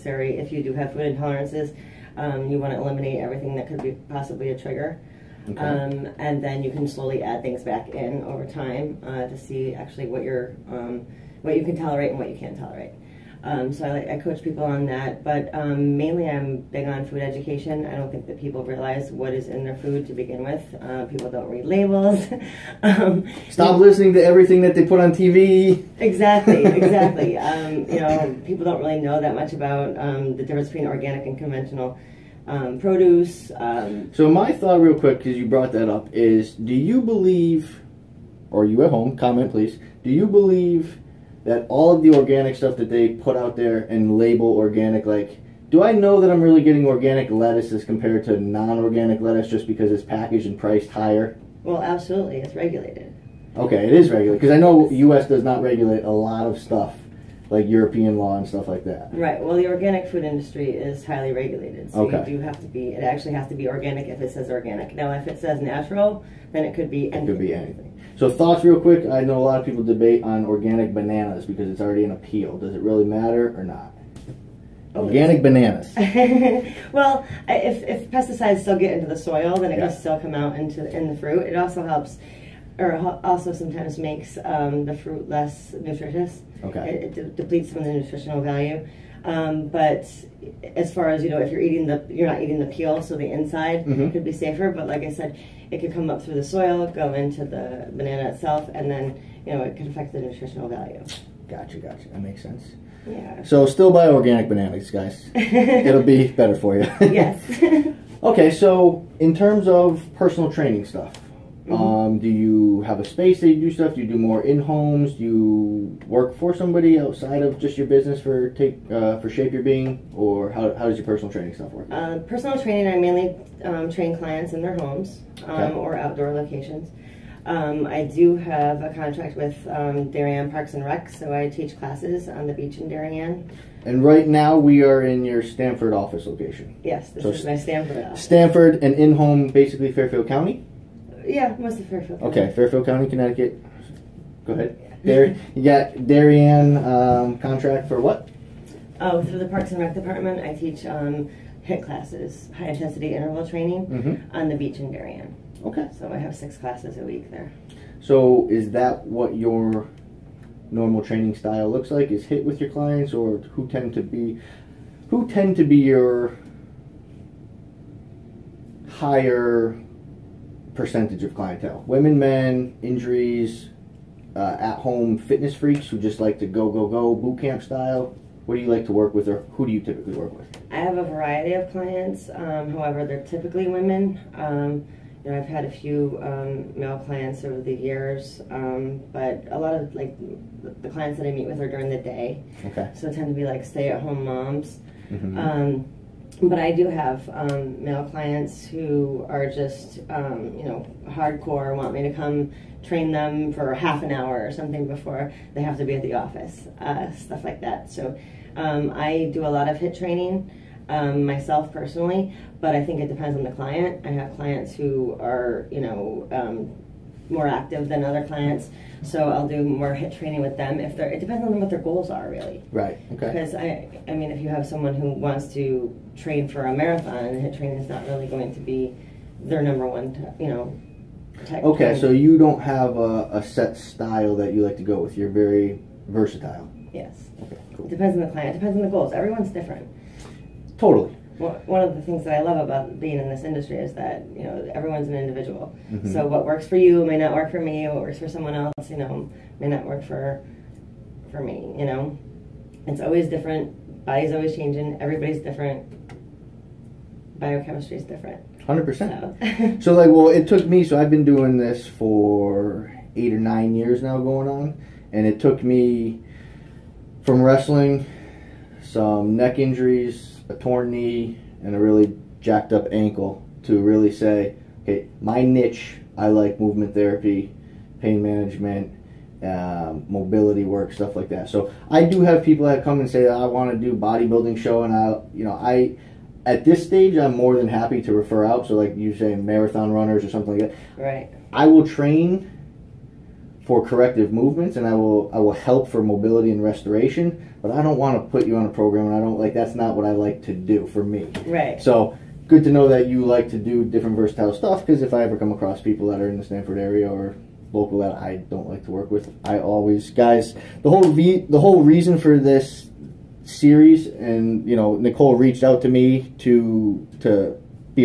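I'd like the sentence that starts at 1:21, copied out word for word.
It also helps, or also sometimes makes um, the fruit less nutritious.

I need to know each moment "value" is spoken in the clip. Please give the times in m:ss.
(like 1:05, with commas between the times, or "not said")
1:28, 1:40.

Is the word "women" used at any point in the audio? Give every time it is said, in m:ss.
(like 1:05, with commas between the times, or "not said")
2:51, 3:03.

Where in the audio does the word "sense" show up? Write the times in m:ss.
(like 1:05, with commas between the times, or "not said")
1:42.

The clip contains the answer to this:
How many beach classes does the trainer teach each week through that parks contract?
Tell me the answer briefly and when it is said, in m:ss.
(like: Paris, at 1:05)
6, at 2:36.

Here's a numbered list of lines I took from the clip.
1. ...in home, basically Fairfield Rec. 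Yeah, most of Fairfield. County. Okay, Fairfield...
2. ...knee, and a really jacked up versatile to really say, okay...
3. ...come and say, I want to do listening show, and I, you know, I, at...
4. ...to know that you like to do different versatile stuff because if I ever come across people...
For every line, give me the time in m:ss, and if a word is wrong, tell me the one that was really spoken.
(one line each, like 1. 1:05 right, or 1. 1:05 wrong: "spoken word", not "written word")
1. 2:18 wrong: "County", not "Rec"
2. 4:30 wrong: "ankle", not "versatile"
3. 4:42 wrong: "bodybuilding", not "listening"
4. 5:02 right.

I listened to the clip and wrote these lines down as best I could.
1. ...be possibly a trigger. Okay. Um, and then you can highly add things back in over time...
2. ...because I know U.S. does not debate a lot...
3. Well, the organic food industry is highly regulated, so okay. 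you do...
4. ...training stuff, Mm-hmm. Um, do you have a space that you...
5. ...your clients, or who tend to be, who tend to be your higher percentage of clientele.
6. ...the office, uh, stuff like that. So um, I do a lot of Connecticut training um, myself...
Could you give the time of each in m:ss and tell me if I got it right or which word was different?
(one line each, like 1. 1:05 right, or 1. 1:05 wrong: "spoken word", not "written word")
1. 0:03 wrong: "slowly", not "highly"
2. 0:54 wrong: "regulate", not "debate"
3. 0:59 right
4. 1:50 right
5. 2:42 right
6. 3:26 wrong: "HIIT", not "Connecticut".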